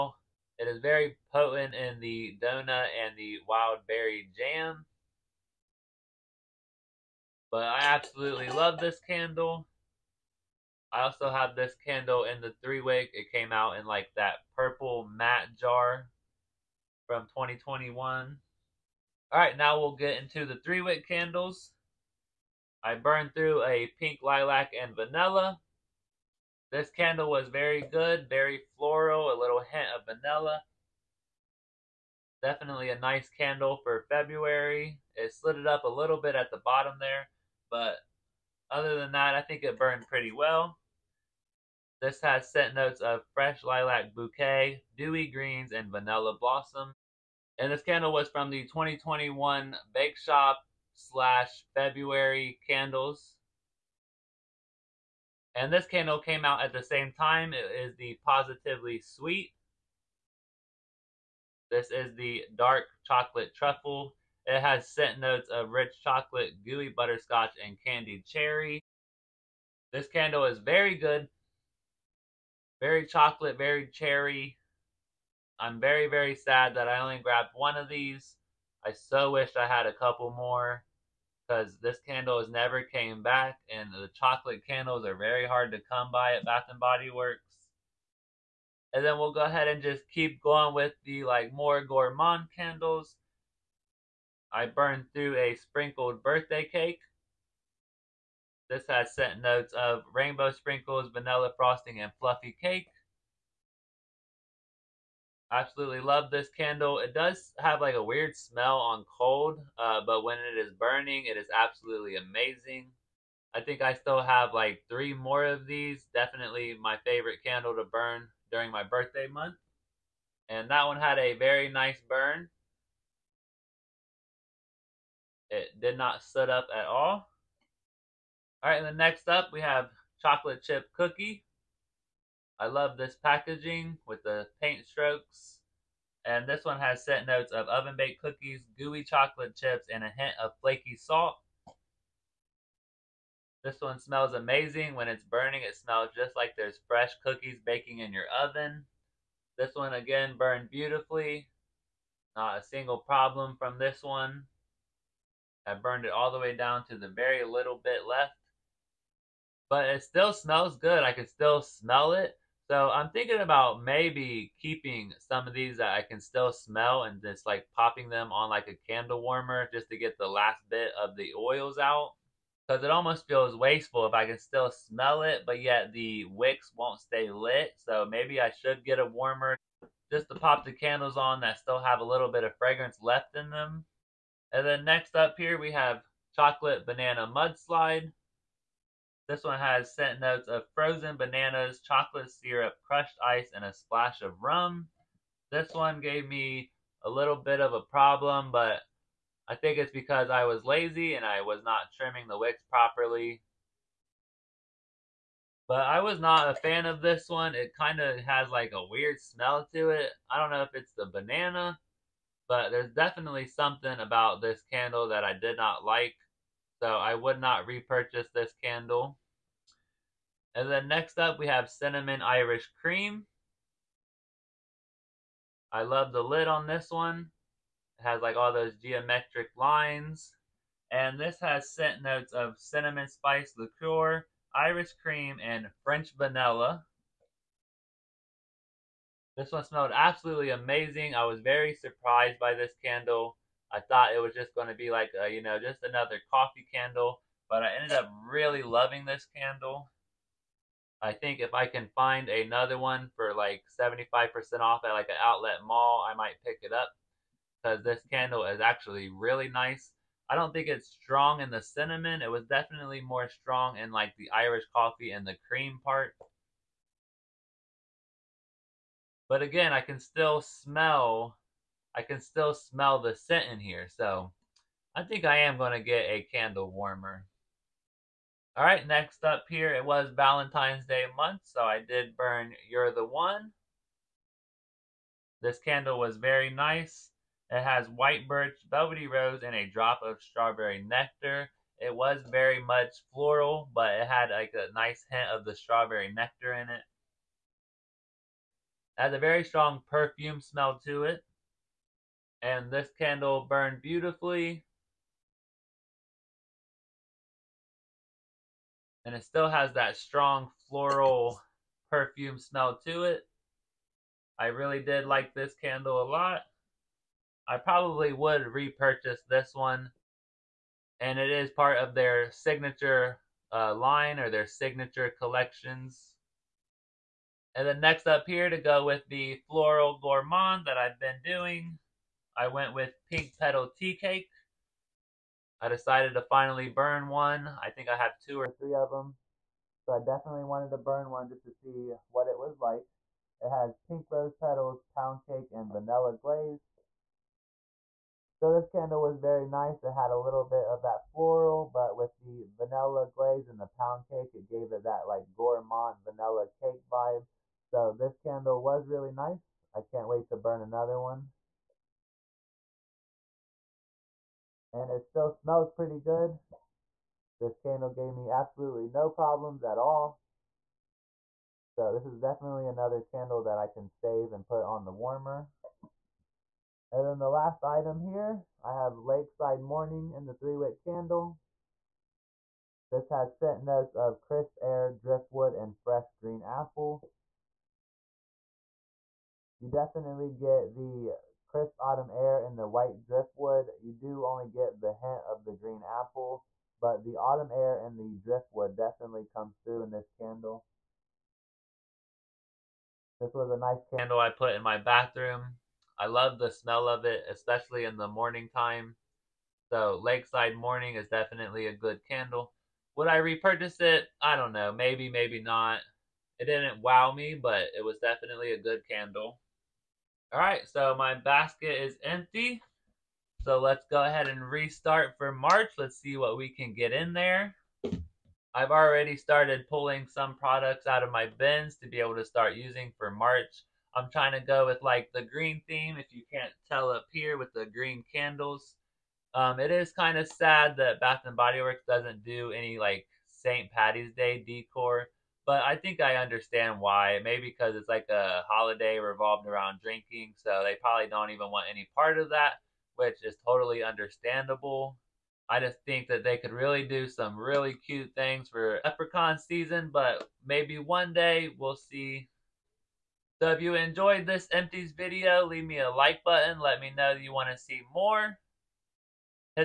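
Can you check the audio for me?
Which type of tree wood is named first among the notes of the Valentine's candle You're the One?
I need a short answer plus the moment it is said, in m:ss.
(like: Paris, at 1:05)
white birch, at 4:47.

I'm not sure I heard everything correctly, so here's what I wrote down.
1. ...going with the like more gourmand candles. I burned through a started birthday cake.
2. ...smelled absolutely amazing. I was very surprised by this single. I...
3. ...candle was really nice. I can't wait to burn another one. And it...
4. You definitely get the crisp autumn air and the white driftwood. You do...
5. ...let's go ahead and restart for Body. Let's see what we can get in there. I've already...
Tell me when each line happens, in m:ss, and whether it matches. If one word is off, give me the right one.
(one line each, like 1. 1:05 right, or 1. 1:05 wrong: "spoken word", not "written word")
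1. 1:30 wrong: "sprinkled", not "started"
2. 3:59 wrong: "candle", not "single"
3. 5:58 right
4. 6:29 right
5. 7:03 wrong: "March", not "Body".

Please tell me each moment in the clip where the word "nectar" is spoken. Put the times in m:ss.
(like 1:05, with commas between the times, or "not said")
4:50, 4:56.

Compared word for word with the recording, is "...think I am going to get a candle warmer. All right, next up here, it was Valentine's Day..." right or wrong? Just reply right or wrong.
right.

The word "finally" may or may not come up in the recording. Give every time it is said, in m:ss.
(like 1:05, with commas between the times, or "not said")
5:36.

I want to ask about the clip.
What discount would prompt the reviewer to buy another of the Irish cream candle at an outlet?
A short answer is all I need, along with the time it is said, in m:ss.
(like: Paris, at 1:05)
75% off, at 4:13.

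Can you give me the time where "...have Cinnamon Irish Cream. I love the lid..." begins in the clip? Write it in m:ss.
3:41.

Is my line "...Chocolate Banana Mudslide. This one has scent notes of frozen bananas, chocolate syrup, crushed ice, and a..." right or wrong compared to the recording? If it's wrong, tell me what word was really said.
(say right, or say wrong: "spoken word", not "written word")
right.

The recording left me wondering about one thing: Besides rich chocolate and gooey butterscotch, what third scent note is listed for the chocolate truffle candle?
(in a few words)
candied cherry.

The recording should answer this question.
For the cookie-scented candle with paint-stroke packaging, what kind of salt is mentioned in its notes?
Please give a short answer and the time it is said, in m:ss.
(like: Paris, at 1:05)
flaky salt, at 2:20.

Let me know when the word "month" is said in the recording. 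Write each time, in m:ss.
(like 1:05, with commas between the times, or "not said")
1:59, 4:41.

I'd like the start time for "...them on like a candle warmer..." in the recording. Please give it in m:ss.
2:48.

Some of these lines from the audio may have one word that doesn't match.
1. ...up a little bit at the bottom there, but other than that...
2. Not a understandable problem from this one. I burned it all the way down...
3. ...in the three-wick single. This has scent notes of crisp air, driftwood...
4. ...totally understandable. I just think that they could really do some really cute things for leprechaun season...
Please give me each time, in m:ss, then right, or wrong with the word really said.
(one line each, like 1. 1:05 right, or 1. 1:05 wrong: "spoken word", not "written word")
1. 0:35 right
2. 2:32 wrong: "single", not "understandable"
3. 6:20 wrong: "candle", not "single"
4. 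7:33 right.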